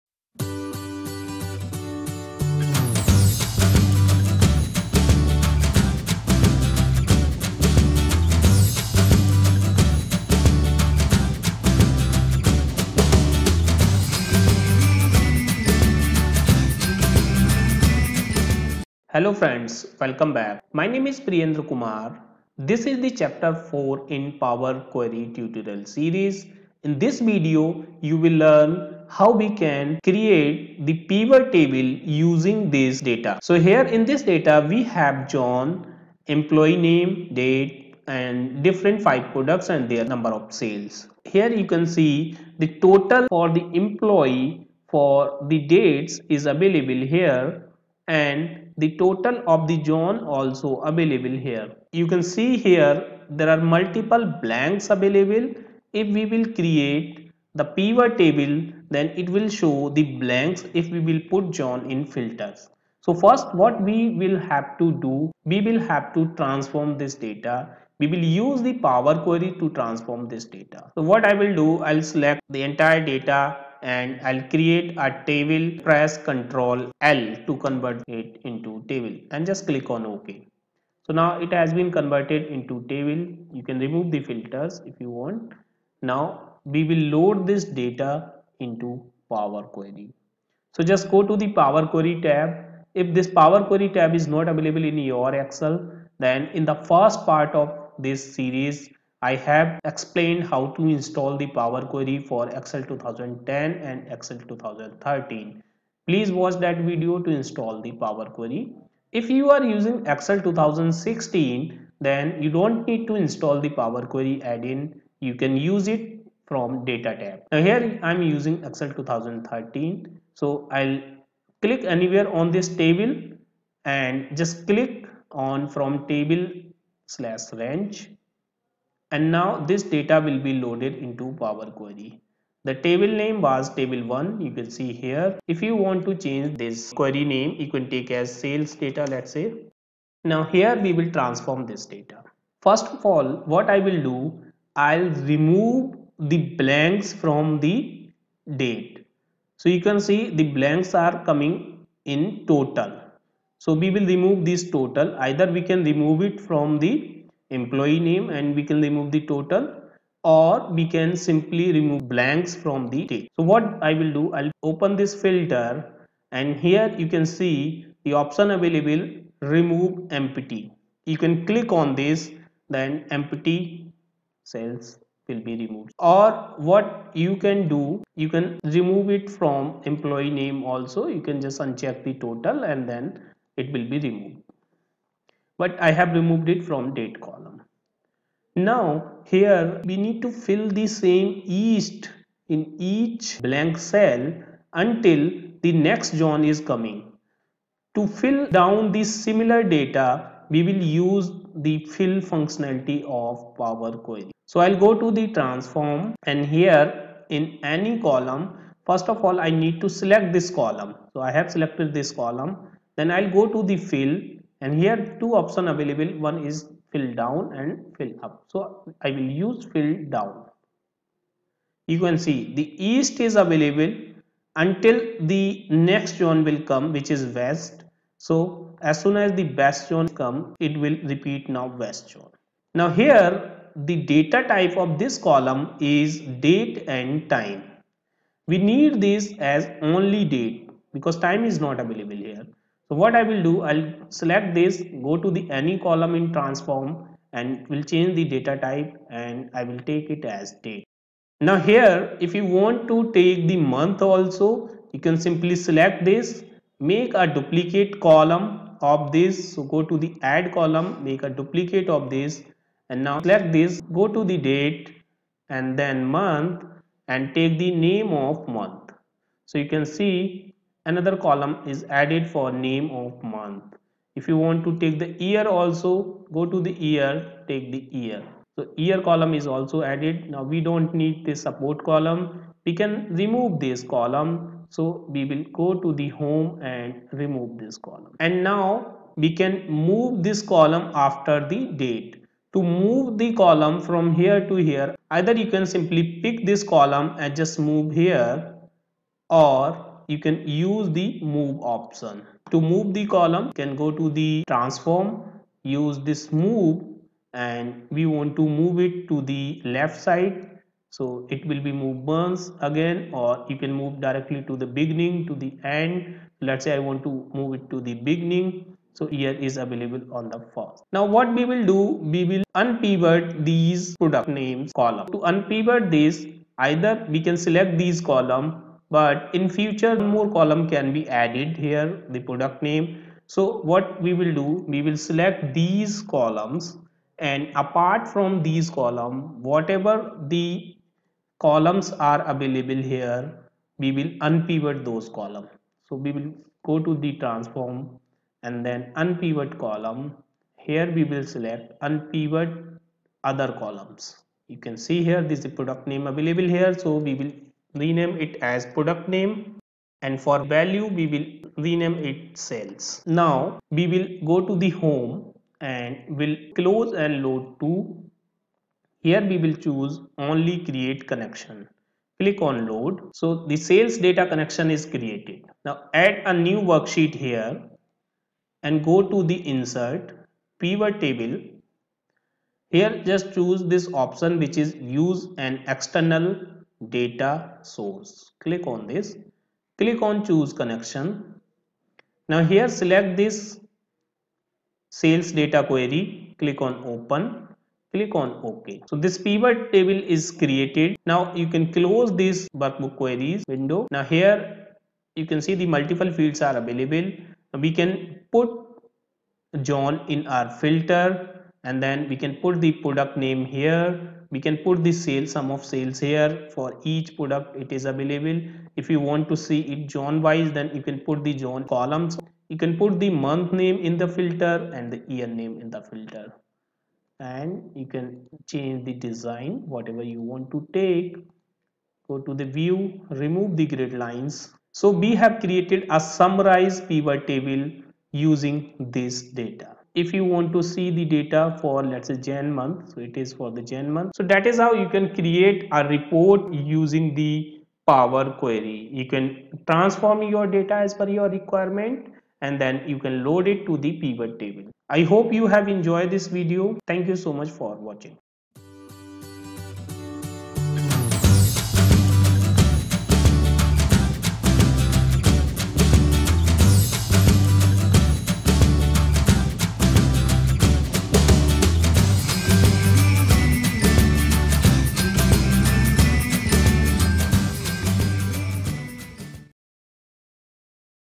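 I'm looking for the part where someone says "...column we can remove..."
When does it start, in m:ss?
4:41.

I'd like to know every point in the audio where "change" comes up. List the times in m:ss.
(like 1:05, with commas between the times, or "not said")
2:16, 4:07, 7:08.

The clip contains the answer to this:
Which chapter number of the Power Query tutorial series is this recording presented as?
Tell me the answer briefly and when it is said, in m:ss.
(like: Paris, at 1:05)
4, at 0:23.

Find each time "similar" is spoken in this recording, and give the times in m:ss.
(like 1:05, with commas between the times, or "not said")
3:19.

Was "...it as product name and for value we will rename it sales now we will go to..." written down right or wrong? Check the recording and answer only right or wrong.
right.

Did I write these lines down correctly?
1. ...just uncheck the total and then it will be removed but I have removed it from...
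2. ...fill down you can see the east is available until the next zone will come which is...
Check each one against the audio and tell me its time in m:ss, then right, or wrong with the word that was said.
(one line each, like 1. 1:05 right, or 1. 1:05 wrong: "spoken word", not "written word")
1. 3:01 right
2. 3:39 right.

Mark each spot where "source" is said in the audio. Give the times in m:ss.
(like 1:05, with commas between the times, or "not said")
6:27.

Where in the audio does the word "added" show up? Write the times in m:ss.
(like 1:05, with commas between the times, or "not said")
4:32, 4:39, 5:31.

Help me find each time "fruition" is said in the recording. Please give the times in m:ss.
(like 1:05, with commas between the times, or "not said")
not said.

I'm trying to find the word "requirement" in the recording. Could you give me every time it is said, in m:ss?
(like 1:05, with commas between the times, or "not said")
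7:31.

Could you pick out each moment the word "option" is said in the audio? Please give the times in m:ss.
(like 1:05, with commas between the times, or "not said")
2:48, 3:35, 5:01, 6:23.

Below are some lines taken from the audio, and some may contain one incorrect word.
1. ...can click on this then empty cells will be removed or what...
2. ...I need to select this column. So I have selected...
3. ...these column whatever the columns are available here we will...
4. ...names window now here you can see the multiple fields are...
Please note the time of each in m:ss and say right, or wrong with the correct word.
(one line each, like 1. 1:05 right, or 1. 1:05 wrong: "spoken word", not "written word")
1. 2:51 right
2. 3:29 right
3. 5:38 right
4. 6:42 wrong: "queries", not "names".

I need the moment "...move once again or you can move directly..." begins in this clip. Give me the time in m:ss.
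5:11.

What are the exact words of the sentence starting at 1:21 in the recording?
So now it has been converted into table.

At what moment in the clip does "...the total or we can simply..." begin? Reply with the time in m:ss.
2:39.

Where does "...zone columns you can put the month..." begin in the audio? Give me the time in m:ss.
7:01.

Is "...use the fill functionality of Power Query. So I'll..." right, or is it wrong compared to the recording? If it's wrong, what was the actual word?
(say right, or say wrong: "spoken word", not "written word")
right.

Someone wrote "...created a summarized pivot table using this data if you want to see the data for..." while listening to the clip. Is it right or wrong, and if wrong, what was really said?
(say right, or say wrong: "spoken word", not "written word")
right.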